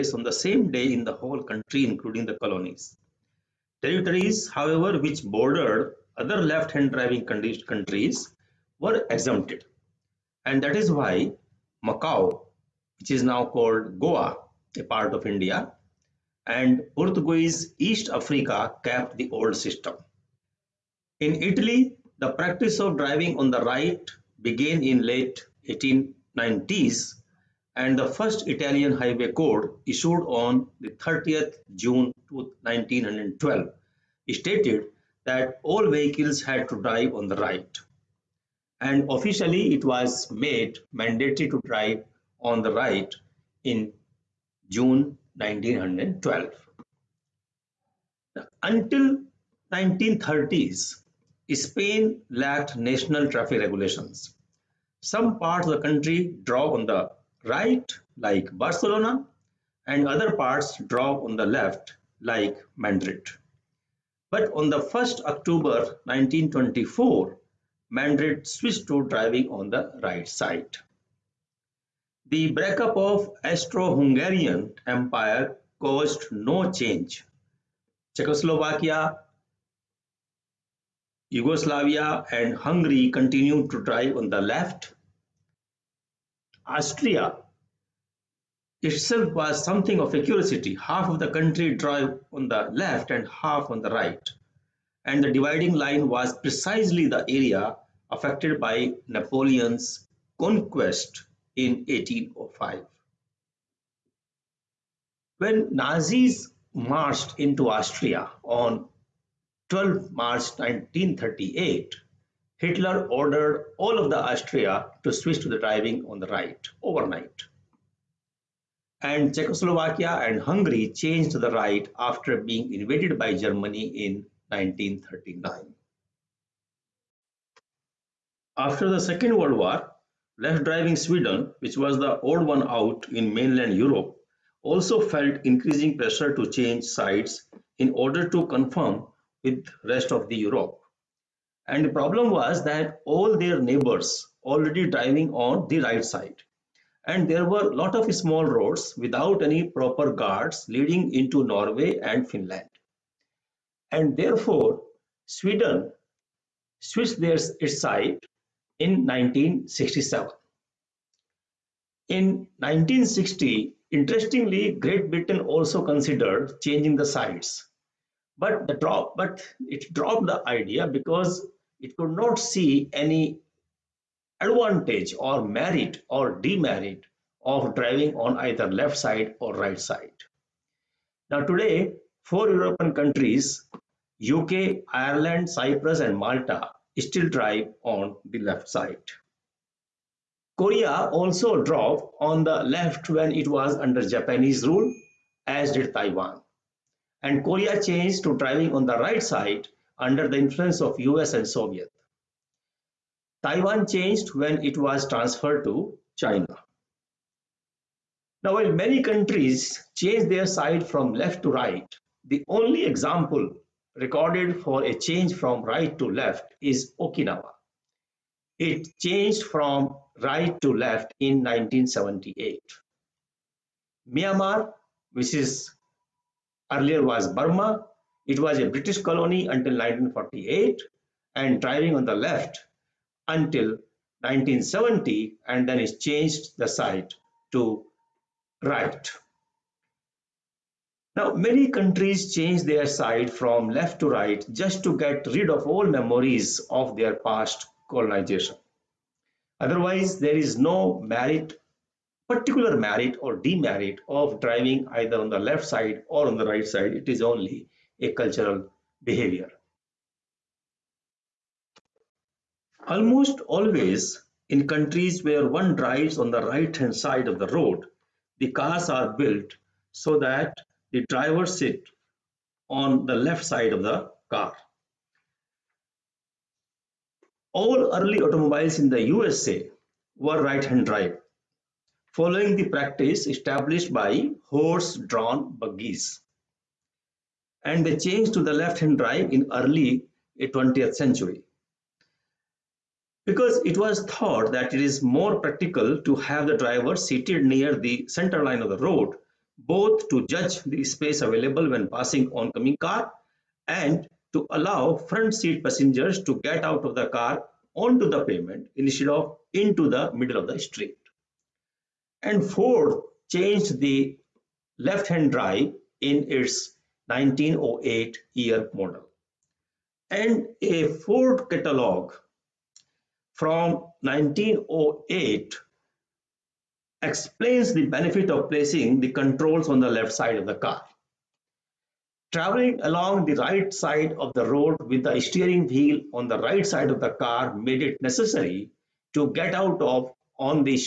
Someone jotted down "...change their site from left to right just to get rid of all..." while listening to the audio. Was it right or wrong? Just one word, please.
right.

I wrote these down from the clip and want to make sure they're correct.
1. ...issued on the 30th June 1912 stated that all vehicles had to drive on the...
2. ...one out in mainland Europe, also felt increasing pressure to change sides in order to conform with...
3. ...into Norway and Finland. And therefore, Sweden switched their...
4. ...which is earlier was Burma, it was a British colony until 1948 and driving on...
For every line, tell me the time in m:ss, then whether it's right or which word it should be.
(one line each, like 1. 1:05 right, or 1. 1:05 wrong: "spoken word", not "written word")
1. 0:29 right
2. 2:12 right
3. 2:31 right
4. 3:45 right.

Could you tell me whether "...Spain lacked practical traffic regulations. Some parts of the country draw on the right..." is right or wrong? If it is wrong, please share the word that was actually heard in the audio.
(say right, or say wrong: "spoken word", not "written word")
wrong: "national", not "practical".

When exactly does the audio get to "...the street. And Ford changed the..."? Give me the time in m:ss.
5:10.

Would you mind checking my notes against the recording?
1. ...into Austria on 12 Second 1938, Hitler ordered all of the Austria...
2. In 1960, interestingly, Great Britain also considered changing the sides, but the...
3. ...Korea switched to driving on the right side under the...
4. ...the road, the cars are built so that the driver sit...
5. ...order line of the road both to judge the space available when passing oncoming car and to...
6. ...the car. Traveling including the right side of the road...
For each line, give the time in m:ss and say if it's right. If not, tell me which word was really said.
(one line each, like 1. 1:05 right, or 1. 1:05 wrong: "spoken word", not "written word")
1. 1:47 wrong: "March", not "Second"
2. 2:42 right
3. 3:17 wrong: "changed", not "switched"
4. 4:27 right
5. 4:58 wrong: "center", not "order"
6. 5:30 wrong: "along", not "including".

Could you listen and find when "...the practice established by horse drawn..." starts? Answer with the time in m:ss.
4:42.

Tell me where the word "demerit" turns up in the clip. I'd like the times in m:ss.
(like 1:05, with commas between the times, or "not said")
2:56, 4:13.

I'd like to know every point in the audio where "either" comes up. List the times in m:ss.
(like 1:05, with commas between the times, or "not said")
2:58, 4:14.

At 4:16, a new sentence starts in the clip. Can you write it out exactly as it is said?
It is only a cultural behavior.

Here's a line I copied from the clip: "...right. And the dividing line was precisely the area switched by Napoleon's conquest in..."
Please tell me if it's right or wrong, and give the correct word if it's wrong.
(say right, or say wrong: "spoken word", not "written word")
wrong: "affected", not "switched".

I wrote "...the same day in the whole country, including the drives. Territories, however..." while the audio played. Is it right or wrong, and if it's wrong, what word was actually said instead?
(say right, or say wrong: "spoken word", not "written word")
wrong: "colonies", not "drives".